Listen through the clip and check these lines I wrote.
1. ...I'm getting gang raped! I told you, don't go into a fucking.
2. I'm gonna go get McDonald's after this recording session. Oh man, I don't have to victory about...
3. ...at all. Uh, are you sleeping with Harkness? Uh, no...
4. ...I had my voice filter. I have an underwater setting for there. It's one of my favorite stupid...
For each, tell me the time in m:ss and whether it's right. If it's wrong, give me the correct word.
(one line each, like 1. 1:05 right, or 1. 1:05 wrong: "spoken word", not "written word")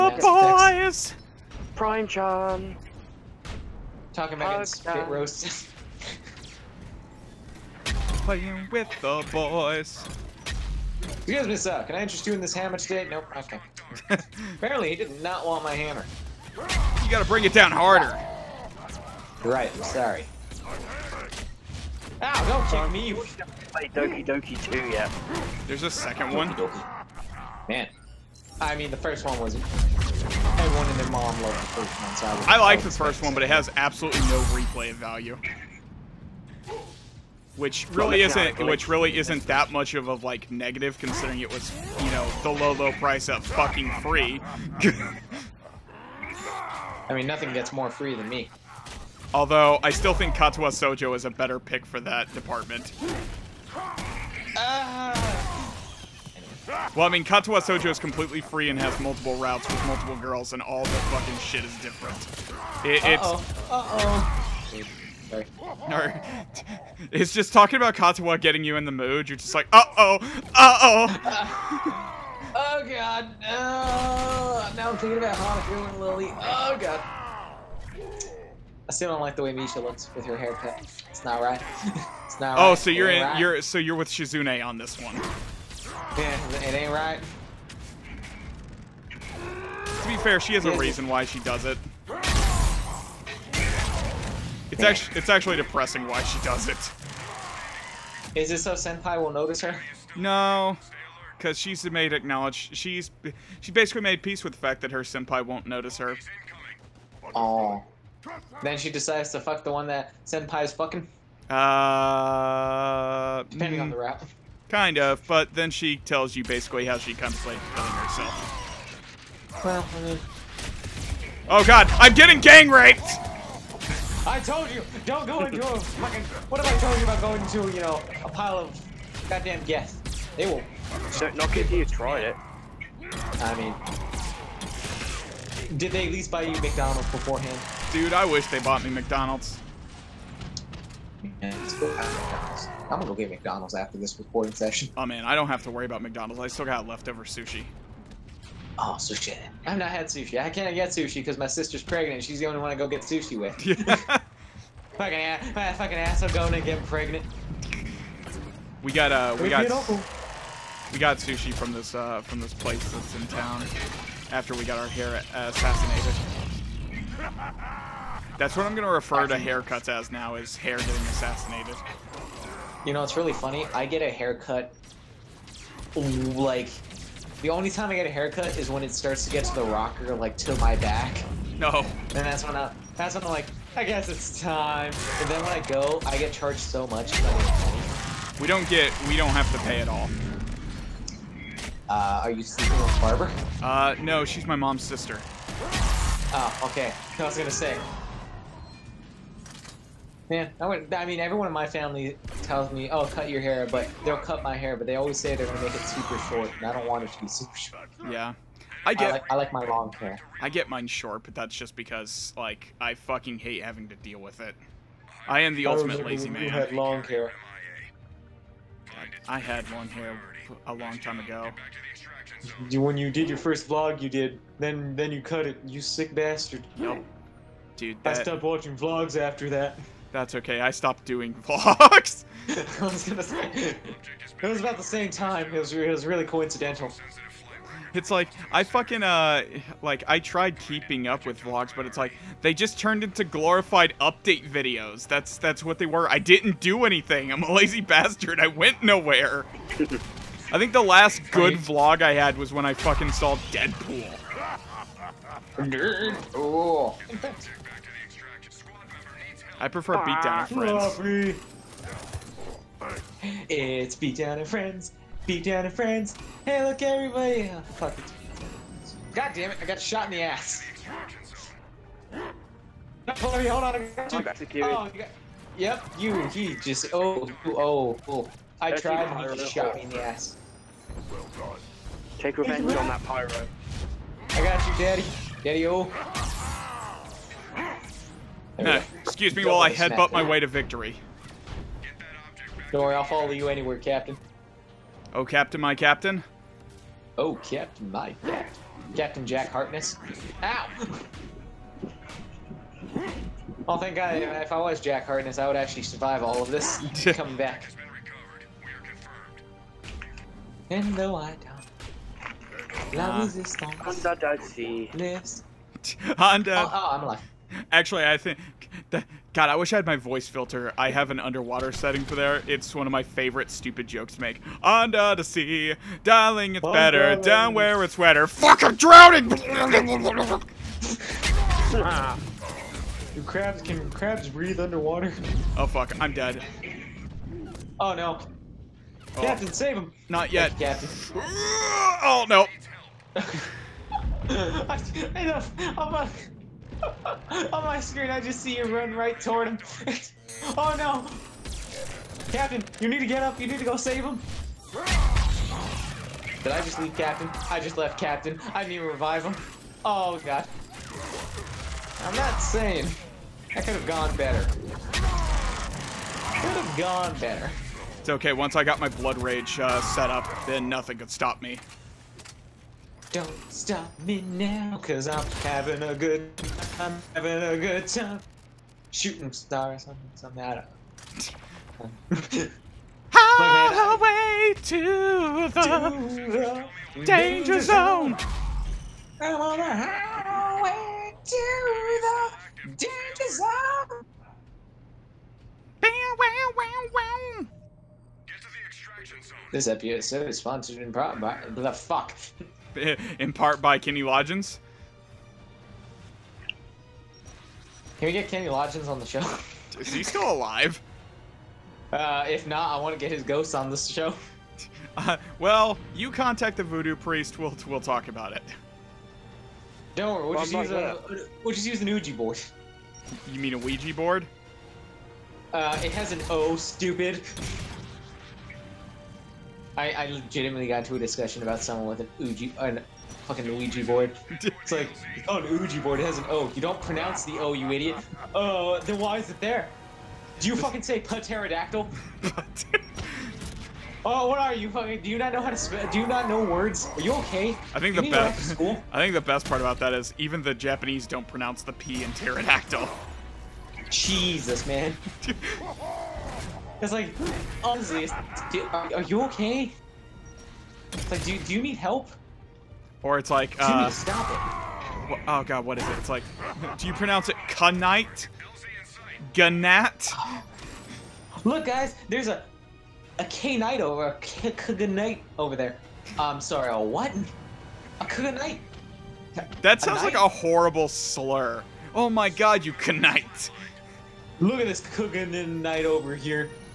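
1. 2:01 right
2. 2:21 wrong: "worry", not "victory"
3. 3:09 wrong: "Barbara", not "Harkness"
4. 5:19 right.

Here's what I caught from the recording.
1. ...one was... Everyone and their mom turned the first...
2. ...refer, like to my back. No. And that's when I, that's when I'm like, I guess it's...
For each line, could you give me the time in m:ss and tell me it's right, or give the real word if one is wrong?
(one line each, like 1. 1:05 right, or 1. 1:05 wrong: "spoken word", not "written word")
1. 0:29 wrong: "loved", not "turned"
2. 2:59 wrong: "rocker", not "refer".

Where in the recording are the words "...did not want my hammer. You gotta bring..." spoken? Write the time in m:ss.
0:14.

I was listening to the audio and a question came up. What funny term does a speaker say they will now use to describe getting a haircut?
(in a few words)
Hair getting assassinated.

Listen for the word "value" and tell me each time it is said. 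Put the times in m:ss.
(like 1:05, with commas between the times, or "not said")
0:34.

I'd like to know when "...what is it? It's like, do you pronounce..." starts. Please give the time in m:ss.
7:45.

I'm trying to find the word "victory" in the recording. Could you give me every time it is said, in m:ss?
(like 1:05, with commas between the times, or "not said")
4:50.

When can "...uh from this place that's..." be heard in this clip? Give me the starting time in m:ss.
2:41.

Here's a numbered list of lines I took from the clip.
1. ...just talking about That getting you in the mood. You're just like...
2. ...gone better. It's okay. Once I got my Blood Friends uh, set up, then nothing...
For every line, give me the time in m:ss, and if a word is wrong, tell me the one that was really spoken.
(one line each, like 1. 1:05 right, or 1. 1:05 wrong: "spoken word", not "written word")
1. 1:07 wrong: "Katawa", not "That"
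2. 6:06 wrong: "Rage", not "Friends".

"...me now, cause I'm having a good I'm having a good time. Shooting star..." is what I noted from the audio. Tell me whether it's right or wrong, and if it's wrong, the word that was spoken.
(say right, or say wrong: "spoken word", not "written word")
right.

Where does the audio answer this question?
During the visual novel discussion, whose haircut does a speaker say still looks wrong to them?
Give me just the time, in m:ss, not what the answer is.
1:19.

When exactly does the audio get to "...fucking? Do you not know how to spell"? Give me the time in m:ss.
7:24.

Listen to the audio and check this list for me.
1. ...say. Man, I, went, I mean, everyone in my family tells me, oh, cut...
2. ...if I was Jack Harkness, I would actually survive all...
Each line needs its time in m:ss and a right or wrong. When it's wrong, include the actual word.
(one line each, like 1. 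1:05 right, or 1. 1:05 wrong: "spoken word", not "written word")
1. 3:17 right
2. 5:04 right.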